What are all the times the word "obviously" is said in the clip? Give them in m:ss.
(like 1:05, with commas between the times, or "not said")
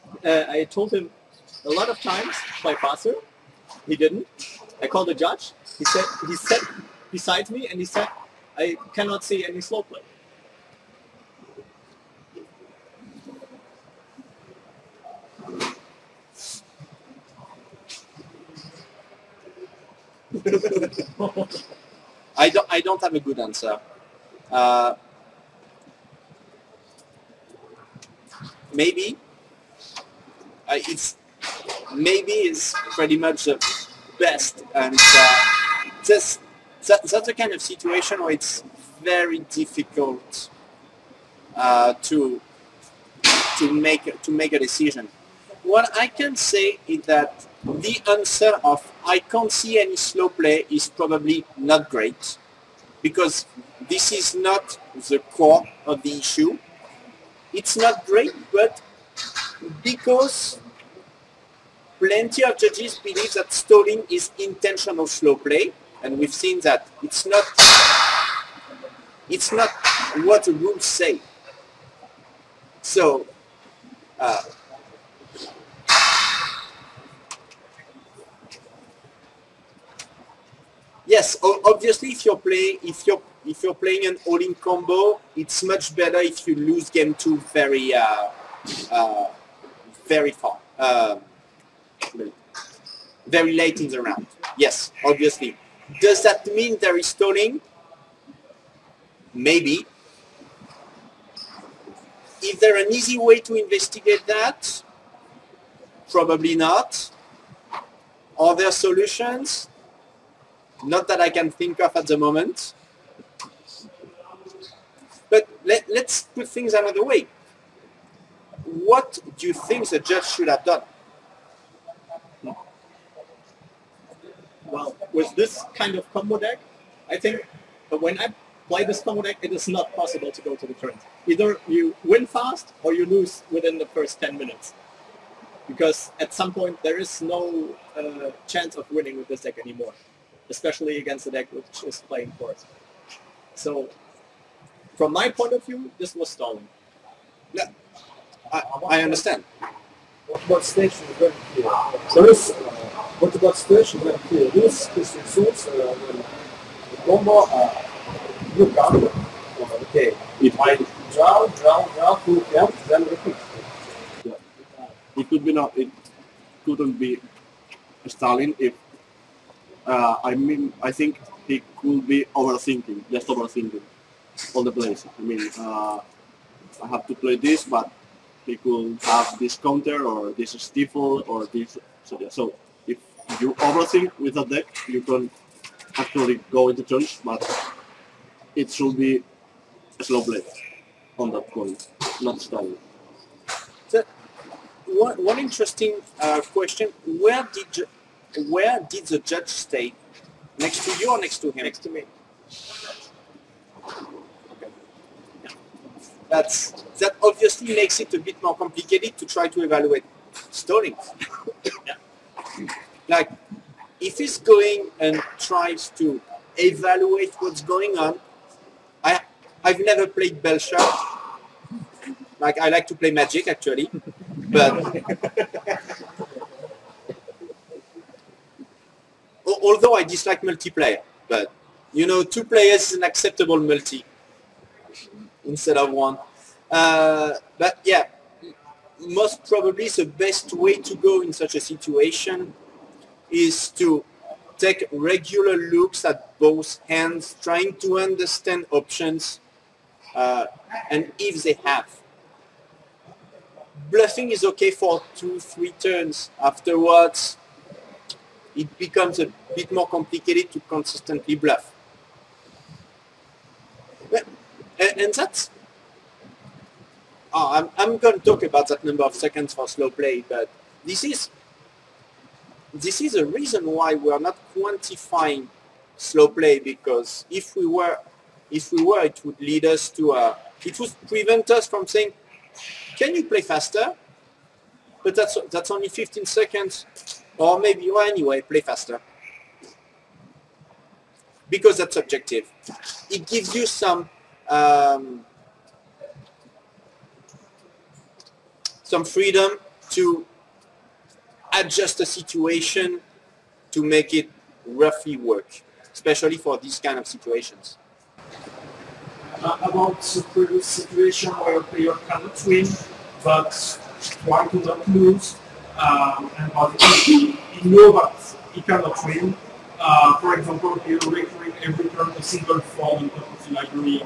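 1:21, 1:35, 3:27.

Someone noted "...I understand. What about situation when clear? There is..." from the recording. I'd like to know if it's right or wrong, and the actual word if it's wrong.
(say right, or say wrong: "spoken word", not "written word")
wrong: "station", not "situation".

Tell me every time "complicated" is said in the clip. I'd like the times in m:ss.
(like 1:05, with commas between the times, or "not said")
3:28, 4:19.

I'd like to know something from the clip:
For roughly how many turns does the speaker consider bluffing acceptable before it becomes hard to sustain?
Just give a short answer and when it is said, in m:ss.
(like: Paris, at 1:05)
2 or 3 turns, at 4:15.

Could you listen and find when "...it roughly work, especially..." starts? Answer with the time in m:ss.
5:04.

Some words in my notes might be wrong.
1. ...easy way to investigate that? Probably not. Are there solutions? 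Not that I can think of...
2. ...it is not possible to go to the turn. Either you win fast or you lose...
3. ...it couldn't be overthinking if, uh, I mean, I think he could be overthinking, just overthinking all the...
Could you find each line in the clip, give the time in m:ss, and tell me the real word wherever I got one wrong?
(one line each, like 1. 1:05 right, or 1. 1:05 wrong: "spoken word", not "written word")
1. 1:42 right
2. 2:09 right
3. 2:45 wrong: "stalling", not "overthinking".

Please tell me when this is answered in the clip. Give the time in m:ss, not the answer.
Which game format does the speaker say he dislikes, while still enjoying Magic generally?
3:50.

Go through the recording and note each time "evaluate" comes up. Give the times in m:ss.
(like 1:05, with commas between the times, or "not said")
3:29, 3:36.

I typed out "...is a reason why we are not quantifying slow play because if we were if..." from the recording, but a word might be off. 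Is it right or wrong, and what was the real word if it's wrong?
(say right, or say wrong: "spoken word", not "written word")
right.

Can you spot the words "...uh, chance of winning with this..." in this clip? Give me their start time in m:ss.
2:17.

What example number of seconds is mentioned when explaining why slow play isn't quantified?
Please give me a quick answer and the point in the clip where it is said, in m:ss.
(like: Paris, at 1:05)
15, at 4:45.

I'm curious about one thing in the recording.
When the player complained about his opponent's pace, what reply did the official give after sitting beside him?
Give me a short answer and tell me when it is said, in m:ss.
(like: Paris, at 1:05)
I cannot see any slow play, at 0:08.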